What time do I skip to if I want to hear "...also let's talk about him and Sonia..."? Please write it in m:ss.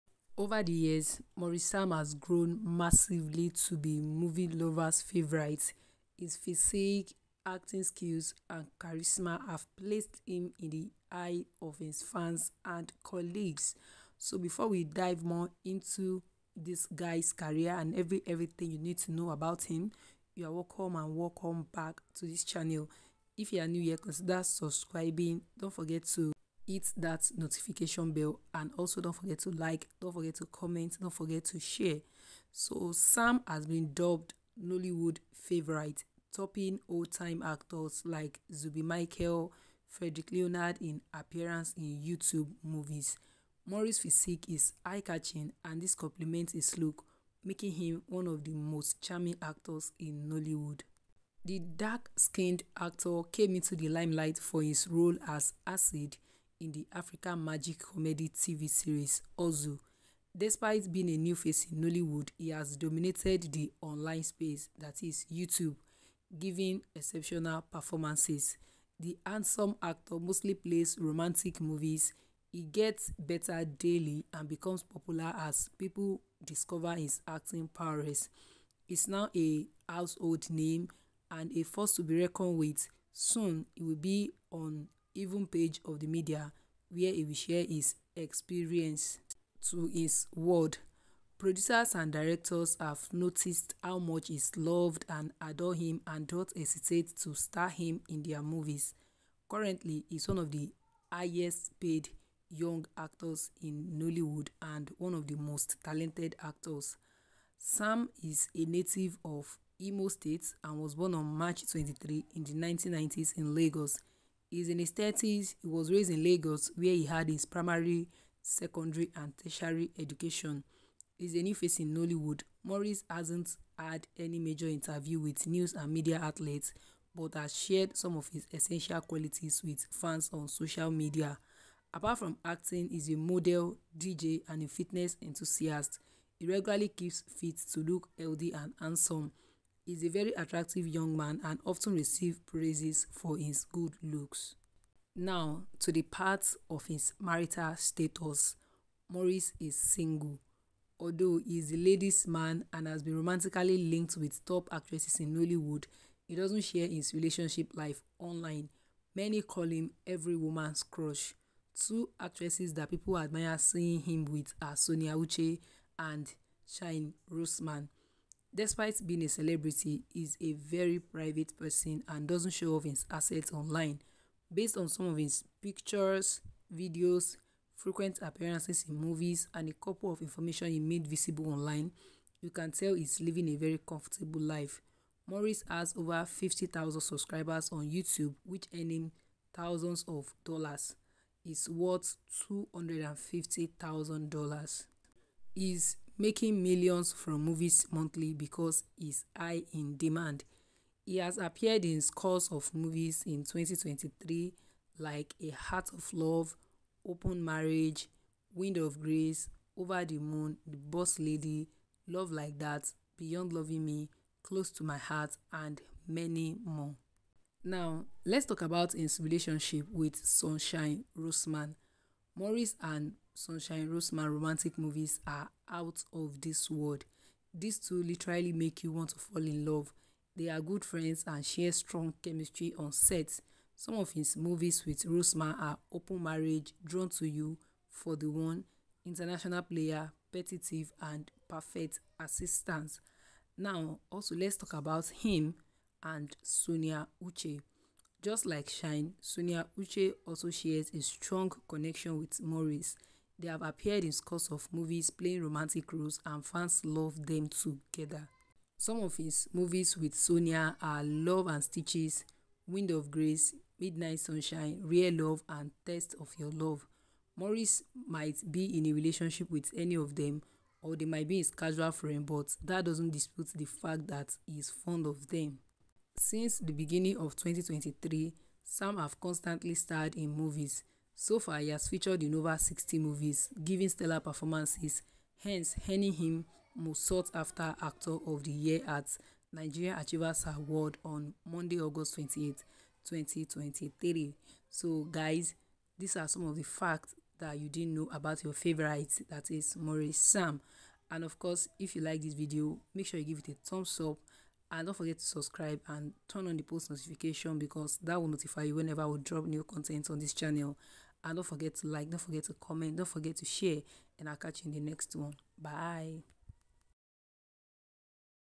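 4:04.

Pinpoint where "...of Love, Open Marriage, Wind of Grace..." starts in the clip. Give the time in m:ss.
3:25.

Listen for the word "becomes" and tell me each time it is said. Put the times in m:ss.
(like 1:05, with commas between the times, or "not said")
1:14.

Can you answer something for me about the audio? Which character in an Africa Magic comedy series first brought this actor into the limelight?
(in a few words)
Acid.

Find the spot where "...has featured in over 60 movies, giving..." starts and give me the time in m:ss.
4:41.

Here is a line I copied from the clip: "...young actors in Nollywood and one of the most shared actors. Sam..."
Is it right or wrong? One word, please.
wrong.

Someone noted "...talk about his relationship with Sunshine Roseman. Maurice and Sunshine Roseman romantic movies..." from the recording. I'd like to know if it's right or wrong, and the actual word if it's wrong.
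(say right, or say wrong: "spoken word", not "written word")
right.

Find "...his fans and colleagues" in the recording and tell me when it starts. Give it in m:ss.
0:11.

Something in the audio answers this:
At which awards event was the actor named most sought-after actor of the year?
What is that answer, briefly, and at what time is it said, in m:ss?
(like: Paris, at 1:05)
Nigeria Achievers Award, at 4:49.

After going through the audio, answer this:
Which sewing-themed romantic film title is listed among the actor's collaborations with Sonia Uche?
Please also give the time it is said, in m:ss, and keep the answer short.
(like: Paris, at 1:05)
Love and Stitches, at 4:21.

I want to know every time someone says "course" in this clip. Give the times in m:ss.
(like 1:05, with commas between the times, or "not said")
5:01.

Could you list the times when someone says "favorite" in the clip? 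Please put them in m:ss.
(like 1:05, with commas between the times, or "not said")
0:04, 0:35, 4:58.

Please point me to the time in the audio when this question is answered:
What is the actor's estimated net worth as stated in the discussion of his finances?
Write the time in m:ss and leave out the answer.
3:12.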